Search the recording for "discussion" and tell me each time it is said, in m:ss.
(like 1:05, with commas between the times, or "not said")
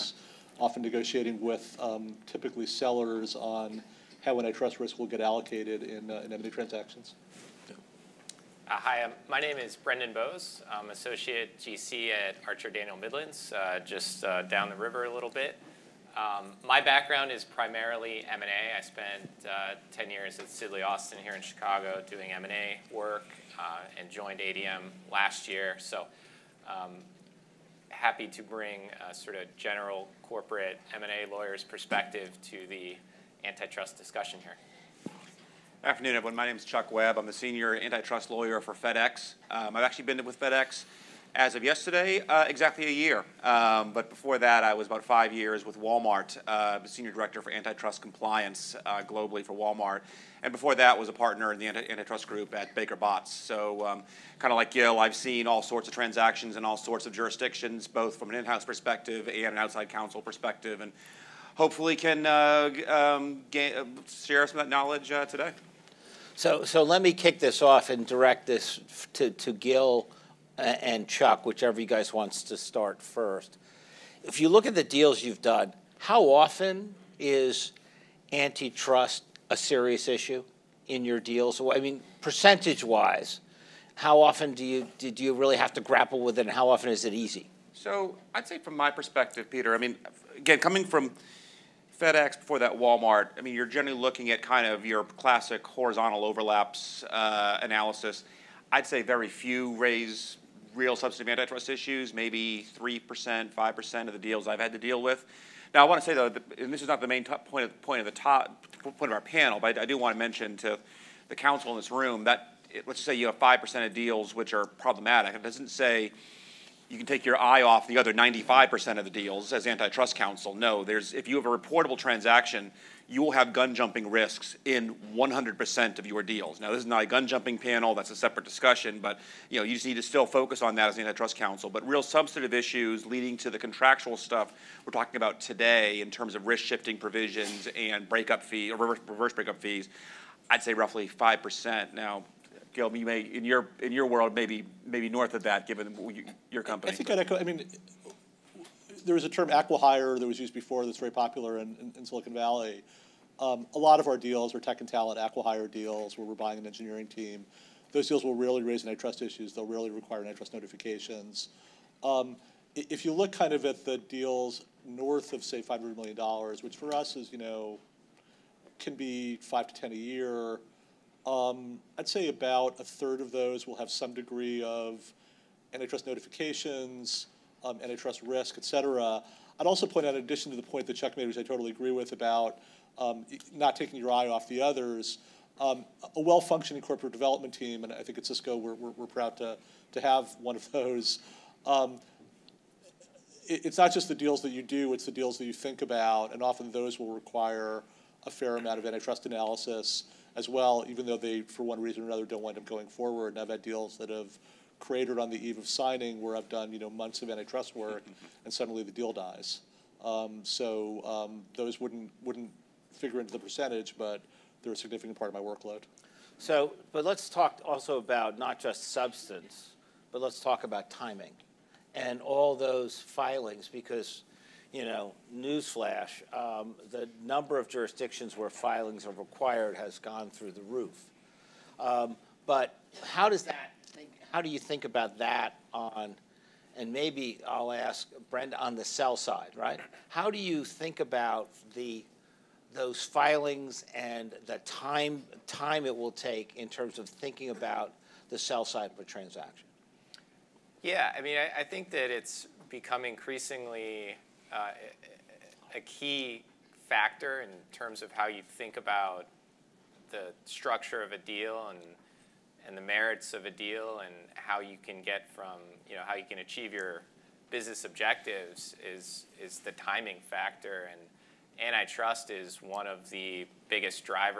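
0:33, 2:08.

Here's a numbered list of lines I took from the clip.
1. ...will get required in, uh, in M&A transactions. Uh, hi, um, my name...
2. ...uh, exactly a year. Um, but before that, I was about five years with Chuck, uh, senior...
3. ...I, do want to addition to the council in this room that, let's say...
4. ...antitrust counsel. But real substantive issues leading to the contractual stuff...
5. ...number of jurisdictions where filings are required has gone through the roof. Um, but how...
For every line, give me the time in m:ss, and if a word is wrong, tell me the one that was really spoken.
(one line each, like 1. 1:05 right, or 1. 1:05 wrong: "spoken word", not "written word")
1. 0:04 wrong: "allocated", not "required"
2. 0:42 wrong: "Walmart", not "Chuck"
3. 1:49 wrong: "mention", not "addition"
4. 2:10 right
5. 3:47 right.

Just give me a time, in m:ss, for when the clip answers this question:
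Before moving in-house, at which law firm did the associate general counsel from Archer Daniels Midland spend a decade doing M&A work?
0:20.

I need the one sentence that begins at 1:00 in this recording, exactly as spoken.
And hopefully can uh, um, gain, uh, share some of that knowledge uh, today.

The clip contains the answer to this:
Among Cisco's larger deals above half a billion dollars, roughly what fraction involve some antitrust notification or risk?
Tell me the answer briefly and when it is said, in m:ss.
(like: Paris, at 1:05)
about a third, at 2:52.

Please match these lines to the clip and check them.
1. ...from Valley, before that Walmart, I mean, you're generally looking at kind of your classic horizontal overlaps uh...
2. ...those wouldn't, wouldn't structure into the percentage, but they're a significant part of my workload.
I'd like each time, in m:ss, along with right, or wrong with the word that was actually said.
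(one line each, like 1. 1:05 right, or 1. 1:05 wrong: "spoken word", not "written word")
1. 1:30 wrong: "FedEx", not "Valley"
2. 3:31 wrong: "figure", not "structure".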